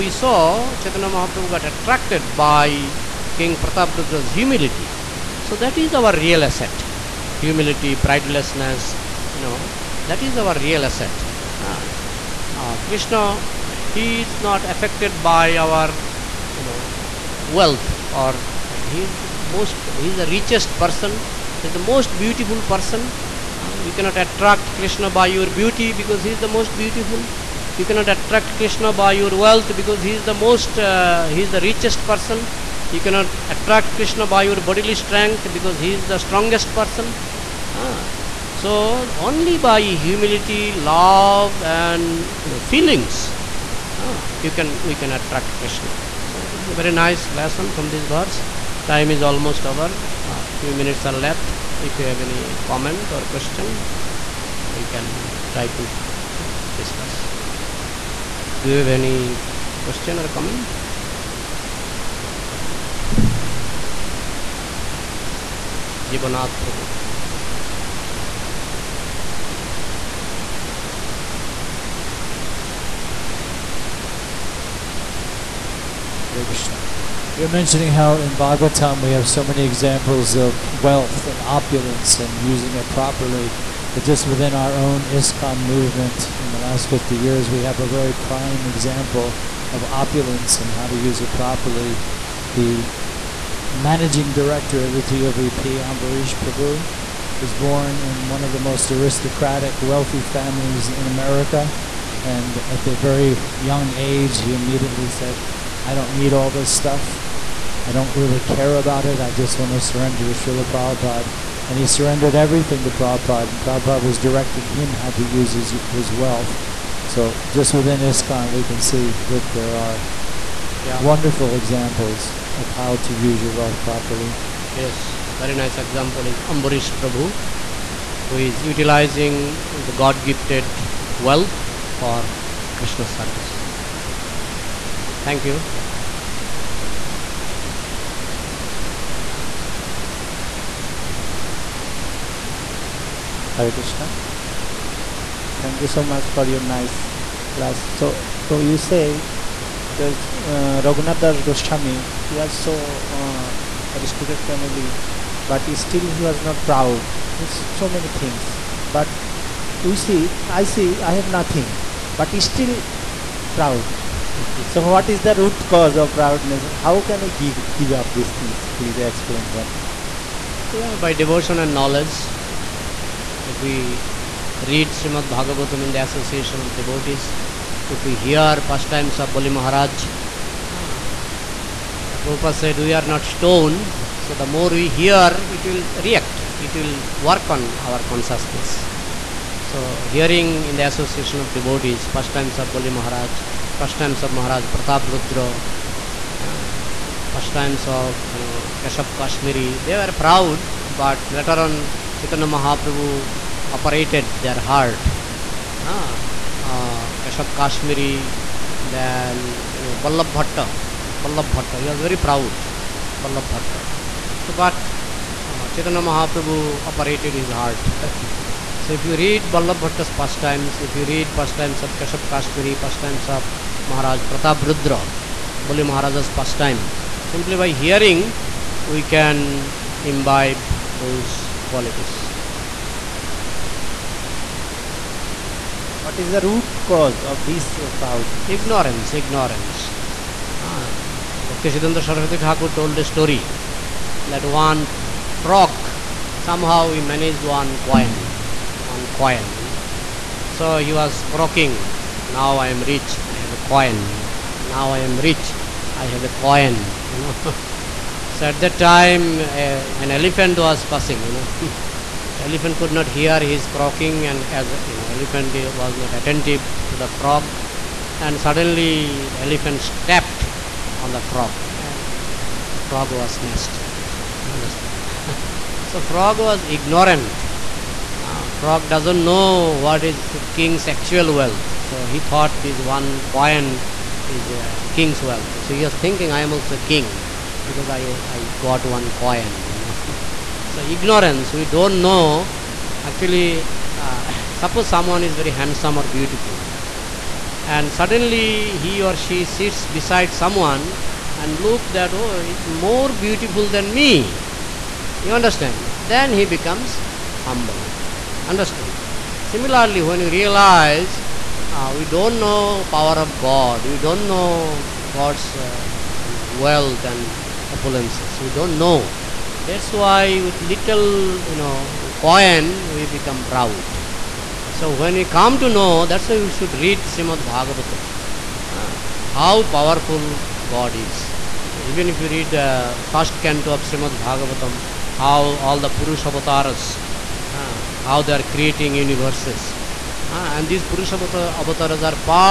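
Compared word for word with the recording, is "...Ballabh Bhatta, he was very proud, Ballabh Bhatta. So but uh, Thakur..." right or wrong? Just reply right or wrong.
wrong.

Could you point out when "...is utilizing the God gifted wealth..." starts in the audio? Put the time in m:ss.
2:08.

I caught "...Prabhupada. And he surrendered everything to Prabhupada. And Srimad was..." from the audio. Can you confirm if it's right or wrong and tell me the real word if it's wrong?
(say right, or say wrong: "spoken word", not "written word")
wrong: "Prabhupada", not "Srimad".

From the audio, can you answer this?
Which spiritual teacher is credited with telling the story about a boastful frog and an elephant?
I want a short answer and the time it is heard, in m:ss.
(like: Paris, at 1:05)
Bhakti Siddhanta Saraswati Thakur, at 4:01.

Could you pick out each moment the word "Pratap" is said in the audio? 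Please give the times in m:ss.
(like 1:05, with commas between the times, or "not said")
0:03, 3:14, 3:44.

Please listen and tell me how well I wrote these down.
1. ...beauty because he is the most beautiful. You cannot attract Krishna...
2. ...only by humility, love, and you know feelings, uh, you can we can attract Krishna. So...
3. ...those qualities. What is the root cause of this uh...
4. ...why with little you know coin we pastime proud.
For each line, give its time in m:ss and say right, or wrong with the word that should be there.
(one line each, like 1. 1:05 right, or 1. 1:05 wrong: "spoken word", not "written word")
1. 0:25 right
2. 0:39 right
3. 3:50 right
4. 5:19 wrong: "become", not "pastime".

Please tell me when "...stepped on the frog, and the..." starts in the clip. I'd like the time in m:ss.
4:29.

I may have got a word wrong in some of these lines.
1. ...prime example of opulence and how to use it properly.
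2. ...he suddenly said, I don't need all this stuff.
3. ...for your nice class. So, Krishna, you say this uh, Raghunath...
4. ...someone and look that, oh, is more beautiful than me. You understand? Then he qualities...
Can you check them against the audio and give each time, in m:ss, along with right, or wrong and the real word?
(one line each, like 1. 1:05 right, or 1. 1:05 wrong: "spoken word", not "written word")
1. 1:28 right
2. 1:44 wrong: "immediately", not "suddenly"
3. 2:26 wrong: "Prabhu", not "Krishna"
4. 5:00 wrong: "becomes", not "qualities".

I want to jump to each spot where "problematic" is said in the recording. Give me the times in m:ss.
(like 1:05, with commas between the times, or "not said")
not said.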